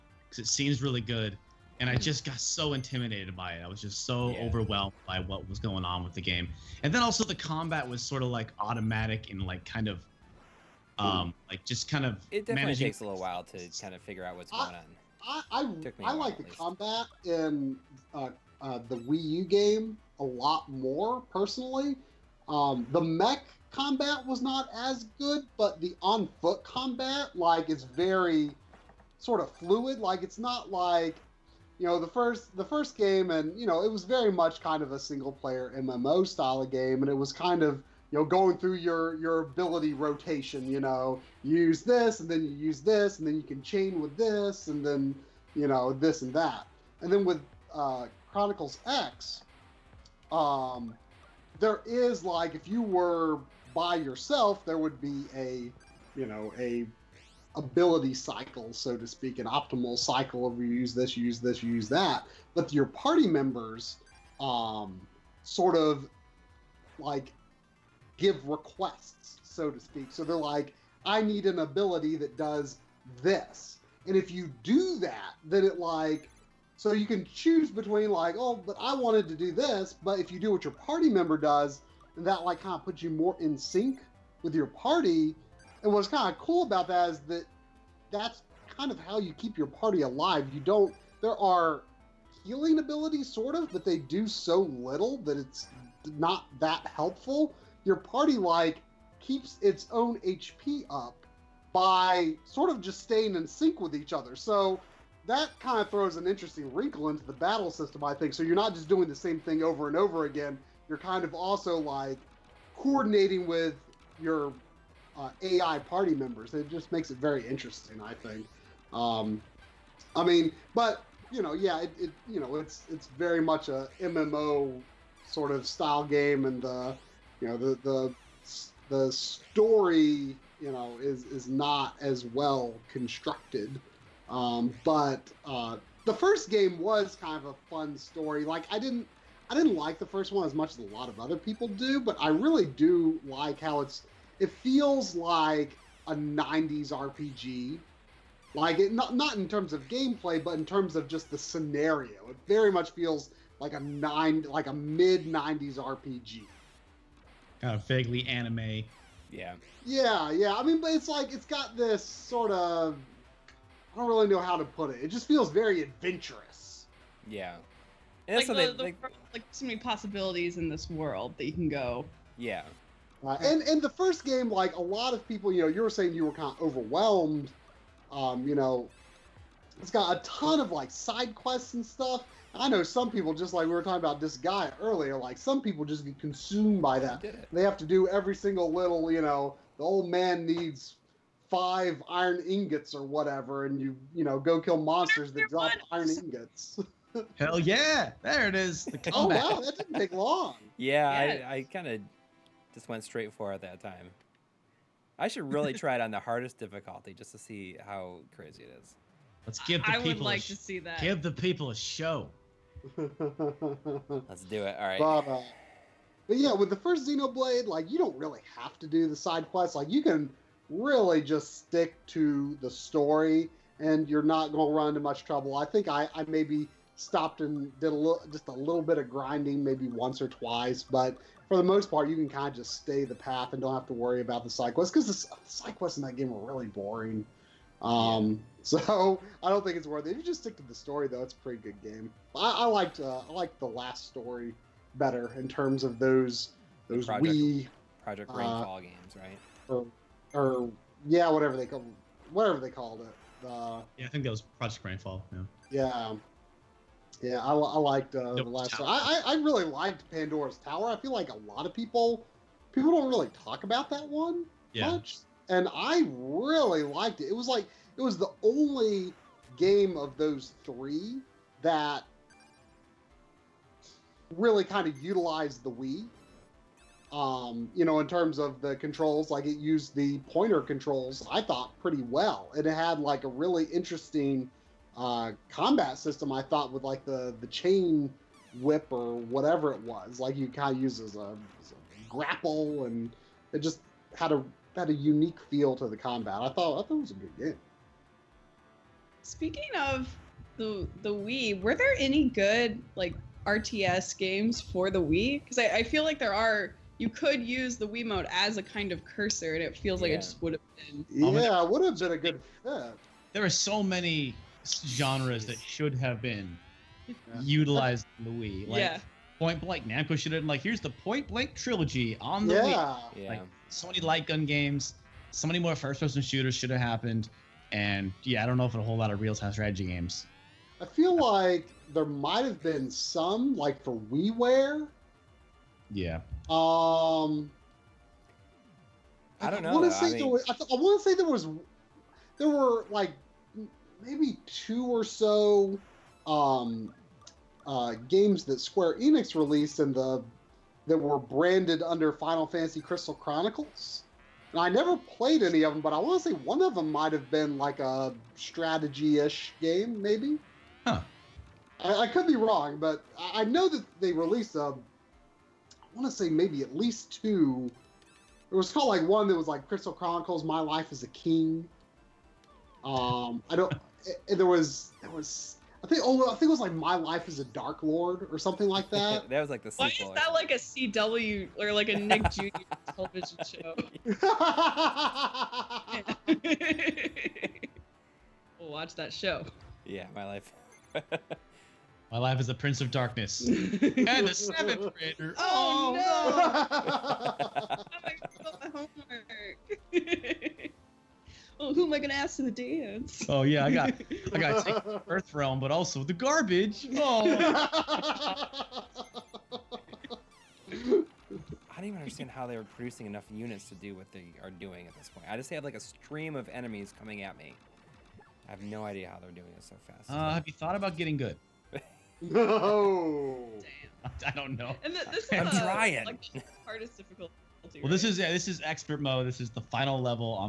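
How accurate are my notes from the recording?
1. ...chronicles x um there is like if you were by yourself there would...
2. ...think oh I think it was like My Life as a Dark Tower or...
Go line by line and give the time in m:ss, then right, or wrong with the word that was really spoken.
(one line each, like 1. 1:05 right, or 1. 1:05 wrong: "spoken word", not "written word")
1. 0:48 right
2. 6:15 wrong: "Lord", not "Tower".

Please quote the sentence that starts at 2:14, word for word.
Um, but uh, the first game was kind of a fun story.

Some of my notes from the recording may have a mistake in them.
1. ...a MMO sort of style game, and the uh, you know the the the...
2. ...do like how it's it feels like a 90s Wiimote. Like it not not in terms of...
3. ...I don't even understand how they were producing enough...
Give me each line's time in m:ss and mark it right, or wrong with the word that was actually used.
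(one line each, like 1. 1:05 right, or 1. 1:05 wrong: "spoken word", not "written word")
1. 2:03 right
2. 2:22 wrong: "RPG", not "Wiimote"
3. 6:50 right.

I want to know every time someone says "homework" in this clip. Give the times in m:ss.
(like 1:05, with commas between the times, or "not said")
6:39.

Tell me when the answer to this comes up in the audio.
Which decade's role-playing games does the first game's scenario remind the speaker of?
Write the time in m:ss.
2:34.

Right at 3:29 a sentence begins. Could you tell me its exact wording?
Let's give the I people would like to see that.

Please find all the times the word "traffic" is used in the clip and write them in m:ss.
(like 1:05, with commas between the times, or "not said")
not said.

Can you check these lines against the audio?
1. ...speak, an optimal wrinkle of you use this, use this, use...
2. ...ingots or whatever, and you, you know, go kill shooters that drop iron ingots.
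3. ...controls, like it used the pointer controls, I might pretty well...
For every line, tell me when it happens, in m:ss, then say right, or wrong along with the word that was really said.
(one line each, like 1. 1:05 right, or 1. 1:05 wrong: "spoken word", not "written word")
1. 0:59 wrong: "cycle", not "wrinkle"
2. 3:12 wrong: "monsters", not "shooters"
3. 4:38 wrong: "thought", not "might".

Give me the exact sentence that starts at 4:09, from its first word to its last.
Or, or yeah, whatever they call whatever they called it.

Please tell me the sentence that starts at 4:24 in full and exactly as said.
much, and I really liked it.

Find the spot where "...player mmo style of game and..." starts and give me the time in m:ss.
0:35.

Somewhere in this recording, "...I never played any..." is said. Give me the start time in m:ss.
5:54.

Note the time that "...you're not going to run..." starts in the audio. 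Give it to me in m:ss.
3:44.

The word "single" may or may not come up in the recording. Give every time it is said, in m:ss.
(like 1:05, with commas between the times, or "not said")
0:34, 3:08.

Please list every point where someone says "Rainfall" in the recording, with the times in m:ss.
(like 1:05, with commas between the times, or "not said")
4:08, 4:14.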